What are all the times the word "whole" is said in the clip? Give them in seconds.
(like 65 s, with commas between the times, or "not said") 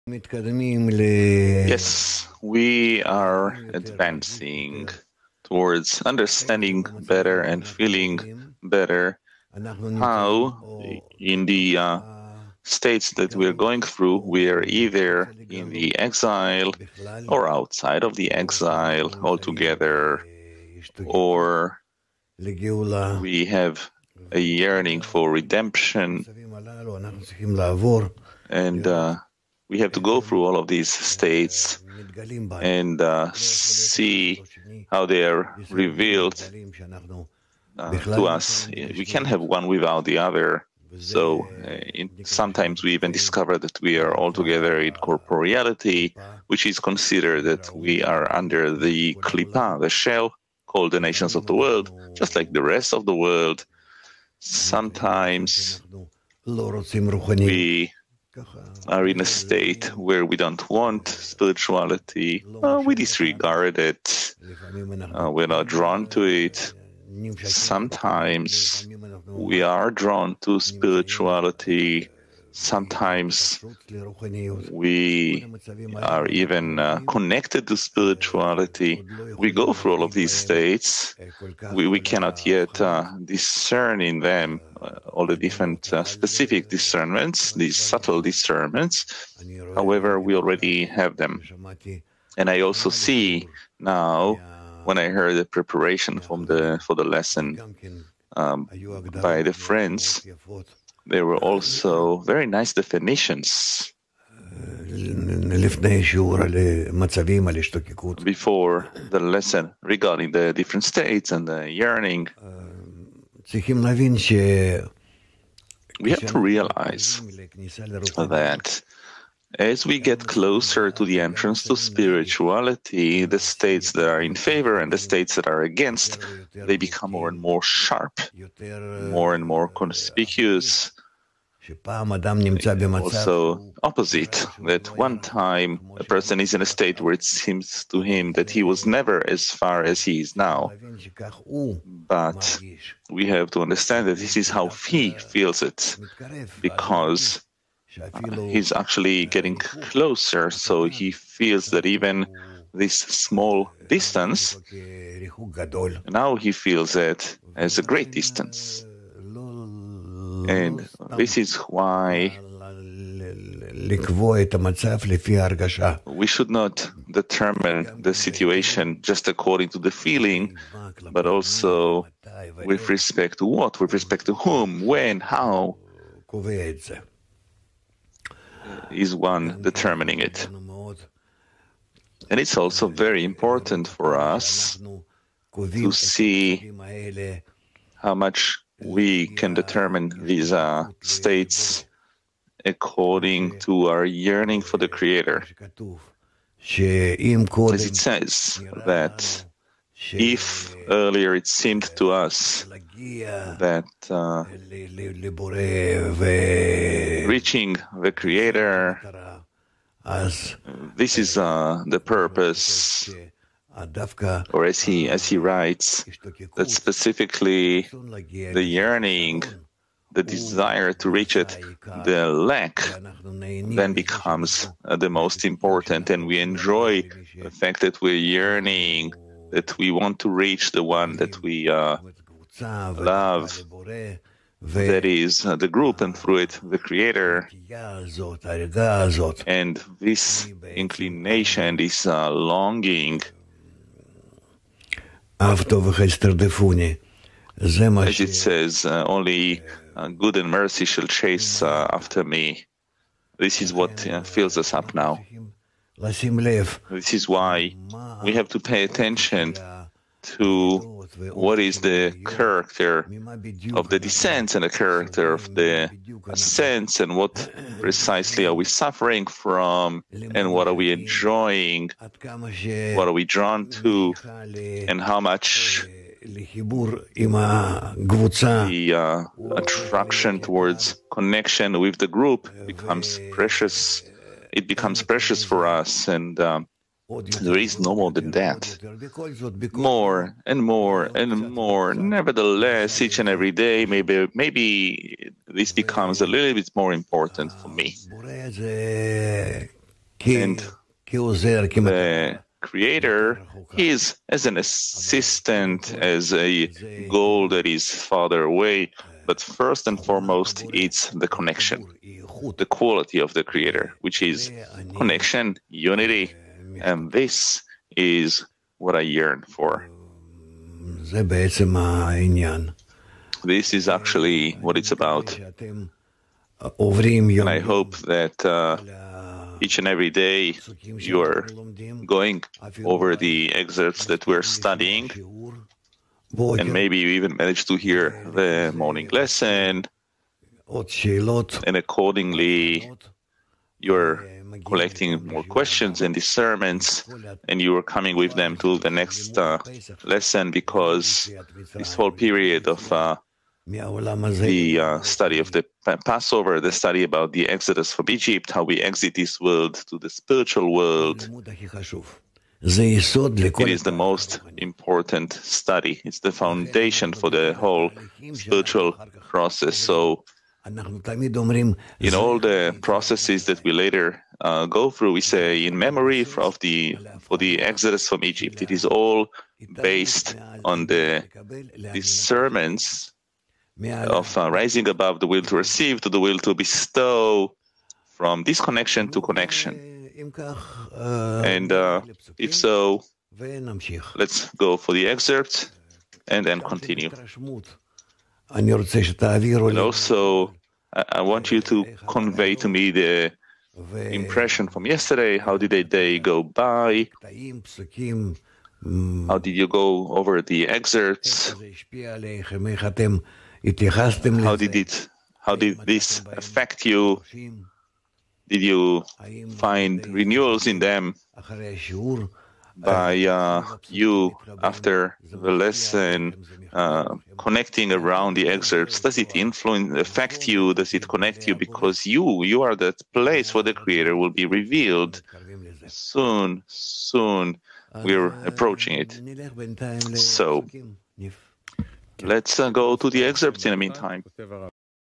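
351 s, 367 s.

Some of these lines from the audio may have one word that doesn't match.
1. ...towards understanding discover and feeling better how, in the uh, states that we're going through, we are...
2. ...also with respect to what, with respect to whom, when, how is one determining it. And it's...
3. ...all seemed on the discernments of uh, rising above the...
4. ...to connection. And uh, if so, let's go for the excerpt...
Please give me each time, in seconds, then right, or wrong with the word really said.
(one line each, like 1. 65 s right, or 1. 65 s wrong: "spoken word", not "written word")
1. 5 s wrong: "better", not "discover"
2. 171 s right
3. 378 s wrong: "based", not "seemed"
4. 389 s right.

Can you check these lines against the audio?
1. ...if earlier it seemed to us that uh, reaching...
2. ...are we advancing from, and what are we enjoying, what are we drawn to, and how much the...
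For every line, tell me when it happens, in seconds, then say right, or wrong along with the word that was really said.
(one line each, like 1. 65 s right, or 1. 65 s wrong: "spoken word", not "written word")
1. 200 s right
2. 268 s wrong: "suffering", not "advancing".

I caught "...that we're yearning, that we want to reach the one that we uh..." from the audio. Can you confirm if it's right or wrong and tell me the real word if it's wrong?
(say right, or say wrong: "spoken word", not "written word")
right.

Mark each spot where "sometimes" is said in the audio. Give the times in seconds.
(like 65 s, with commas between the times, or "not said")
42 s, 54 s, 67 s, 72 s.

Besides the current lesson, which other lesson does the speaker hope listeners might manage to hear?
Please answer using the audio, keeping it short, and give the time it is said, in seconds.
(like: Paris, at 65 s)
the morning lesson, at 338 s.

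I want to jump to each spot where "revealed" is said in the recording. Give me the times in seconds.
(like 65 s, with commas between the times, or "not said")
35 s, 434 s.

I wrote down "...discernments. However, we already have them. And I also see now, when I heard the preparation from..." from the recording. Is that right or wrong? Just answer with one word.
right.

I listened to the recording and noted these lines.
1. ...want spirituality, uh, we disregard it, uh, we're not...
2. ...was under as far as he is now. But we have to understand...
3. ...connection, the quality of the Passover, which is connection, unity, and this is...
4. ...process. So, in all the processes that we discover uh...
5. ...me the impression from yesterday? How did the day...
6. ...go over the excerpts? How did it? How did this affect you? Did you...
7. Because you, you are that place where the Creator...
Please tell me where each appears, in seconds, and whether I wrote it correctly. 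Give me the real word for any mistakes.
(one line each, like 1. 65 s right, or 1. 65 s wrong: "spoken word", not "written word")
1. 60 s right
2. 138 s wrong: "never", not "under"
3. 311 s wrong: "Creator", not "Passover"
4. 369 s wrong: "later", not "discover"
5. 402 s right
6. 409 s right
7. 431 s right.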